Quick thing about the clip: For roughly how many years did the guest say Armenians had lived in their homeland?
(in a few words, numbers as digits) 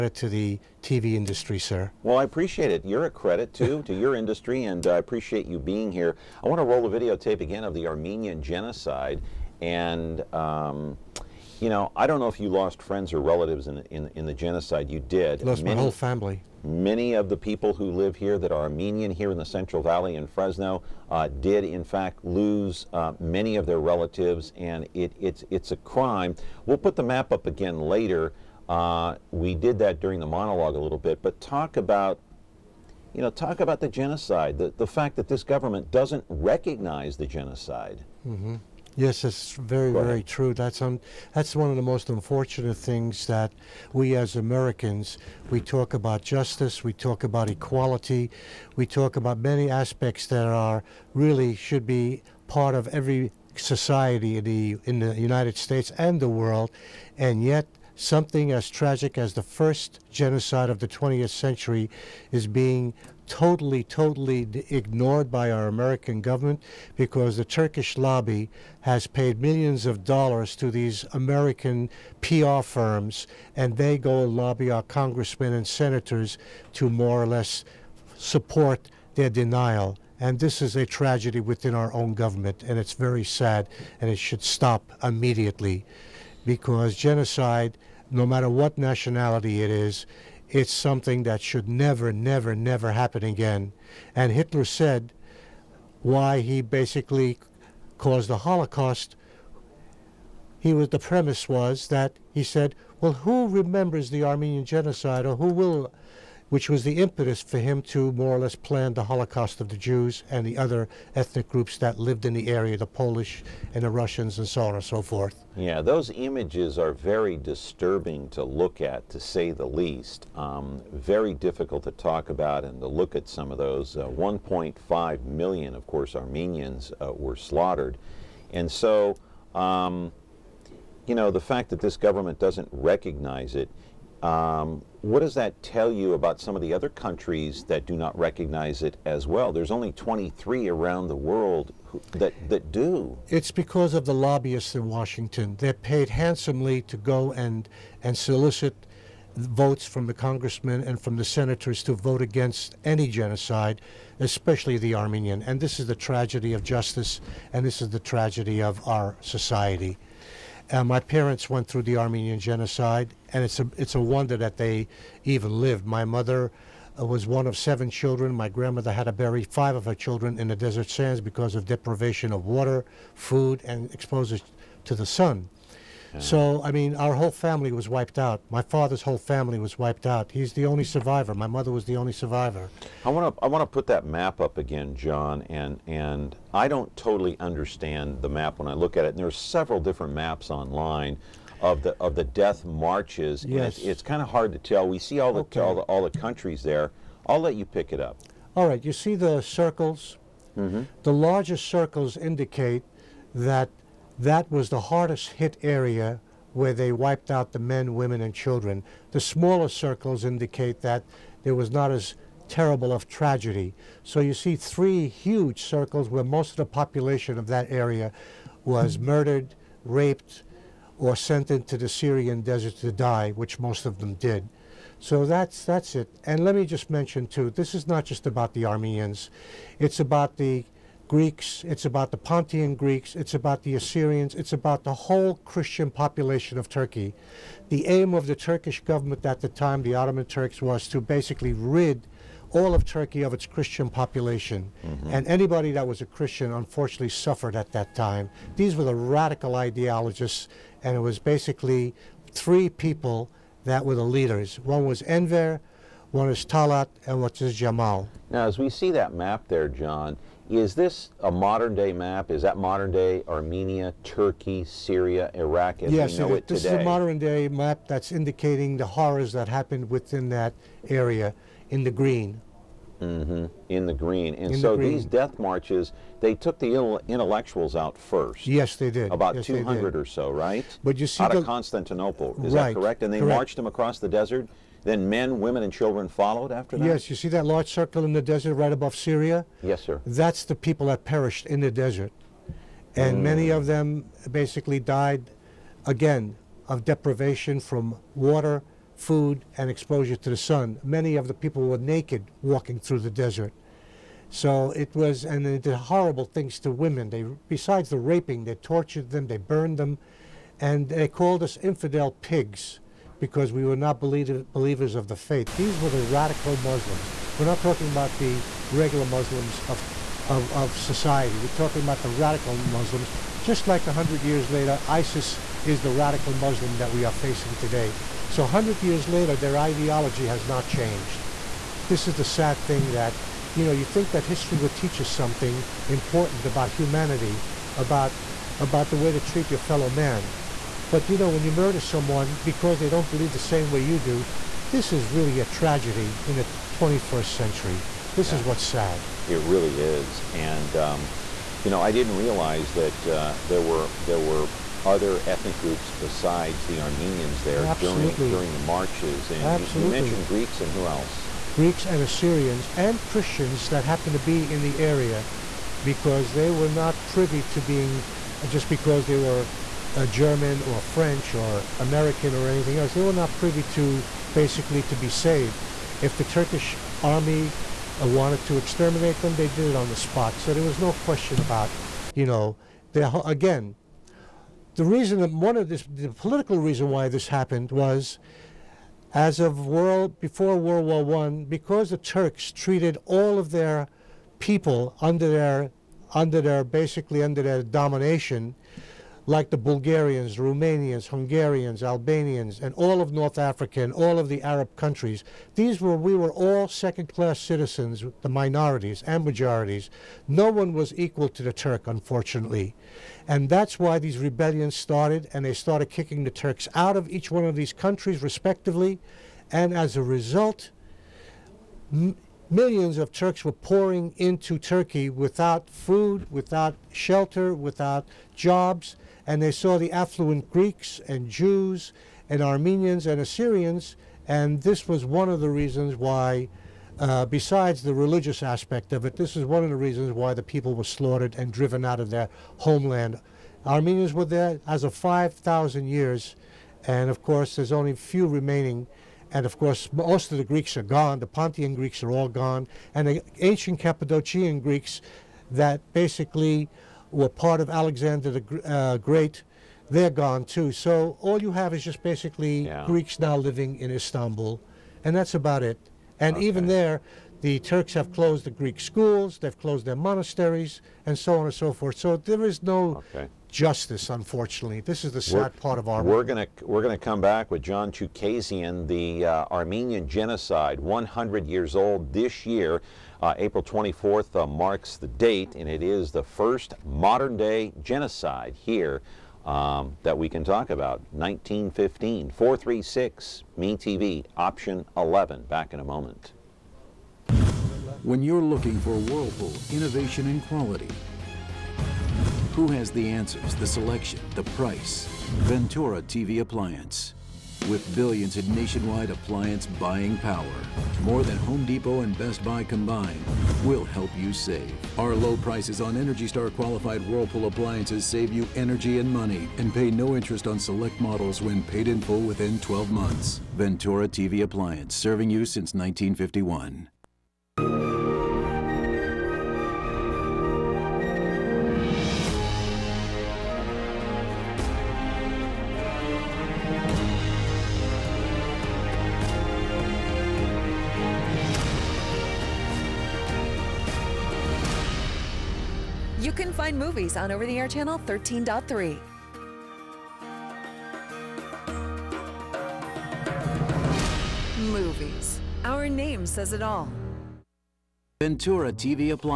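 5,000 years.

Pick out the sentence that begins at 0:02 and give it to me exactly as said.
You're a credit, too, to your industry, and I appreciate you being here.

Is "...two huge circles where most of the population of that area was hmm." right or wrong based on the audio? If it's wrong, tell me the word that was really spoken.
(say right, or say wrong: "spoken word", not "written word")
wrong: "three", not "two".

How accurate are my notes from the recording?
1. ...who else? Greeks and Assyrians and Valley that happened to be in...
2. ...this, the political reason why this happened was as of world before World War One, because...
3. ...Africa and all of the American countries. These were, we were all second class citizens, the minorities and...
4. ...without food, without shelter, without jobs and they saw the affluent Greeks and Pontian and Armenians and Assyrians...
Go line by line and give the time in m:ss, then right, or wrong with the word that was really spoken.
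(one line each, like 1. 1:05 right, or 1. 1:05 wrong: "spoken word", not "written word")
1. 6:00 wrong: "Christians", not "Valley"
2. 6:25 right
3. 6:43 wrong: "Arab", not "American"
4. 7:05 wrong: "Jews", not "Pontian".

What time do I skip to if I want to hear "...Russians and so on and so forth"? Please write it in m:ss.
1:53.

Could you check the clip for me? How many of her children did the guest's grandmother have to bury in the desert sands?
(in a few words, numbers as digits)
5.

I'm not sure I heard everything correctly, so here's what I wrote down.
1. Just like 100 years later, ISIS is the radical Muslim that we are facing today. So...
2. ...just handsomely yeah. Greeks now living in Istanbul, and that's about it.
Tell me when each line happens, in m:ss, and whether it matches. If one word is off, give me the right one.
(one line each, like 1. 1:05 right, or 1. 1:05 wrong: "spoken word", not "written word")
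1. 5:23 right
2. 7:41 wrong: "basically", not "handsomely".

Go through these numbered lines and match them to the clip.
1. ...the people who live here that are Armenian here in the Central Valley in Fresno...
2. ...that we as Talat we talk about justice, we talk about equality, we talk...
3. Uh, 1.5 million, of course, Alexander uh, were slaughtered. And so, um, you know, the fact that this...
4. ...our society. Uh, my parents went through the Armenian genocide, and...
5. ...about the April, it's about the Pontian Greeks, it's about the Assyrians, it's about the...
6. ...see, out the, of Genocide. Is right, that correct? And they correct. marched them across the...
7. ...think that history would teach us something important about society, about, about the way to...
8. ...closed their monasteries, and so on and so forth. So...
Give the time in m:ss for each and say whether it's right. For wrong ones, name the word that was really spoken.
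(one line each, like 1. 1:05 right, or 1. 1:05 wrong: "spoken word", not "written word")
1. 0:17 right
2. 0:43 wrong: "Americans", not "Talat"
3. 2:03 wrong: "Armenians", not "Alexander"
4. 2:38 right
5. 3:49 wrong: "Greeks", not "April"
6. 4:41 wrong: "Constantinople", not "Genocide"
7. 5:33 wrong: "humanity", not "society"
8. 7:49 right.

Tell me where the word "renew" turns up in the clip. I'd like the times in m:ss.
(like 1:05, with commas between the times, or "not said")
not said.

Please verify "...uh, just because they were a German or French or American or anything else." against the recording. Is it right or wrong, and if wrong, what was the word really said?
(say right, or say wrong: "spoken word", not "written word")
right.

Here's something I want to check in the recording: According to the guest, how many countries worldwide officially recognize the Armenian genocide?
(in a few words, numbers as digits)
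23.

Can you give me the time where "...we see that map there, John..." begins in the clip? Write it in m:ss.
4:18.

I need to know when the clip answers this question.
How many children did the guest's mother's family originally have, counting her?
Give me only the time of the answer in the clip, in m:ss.
2:47.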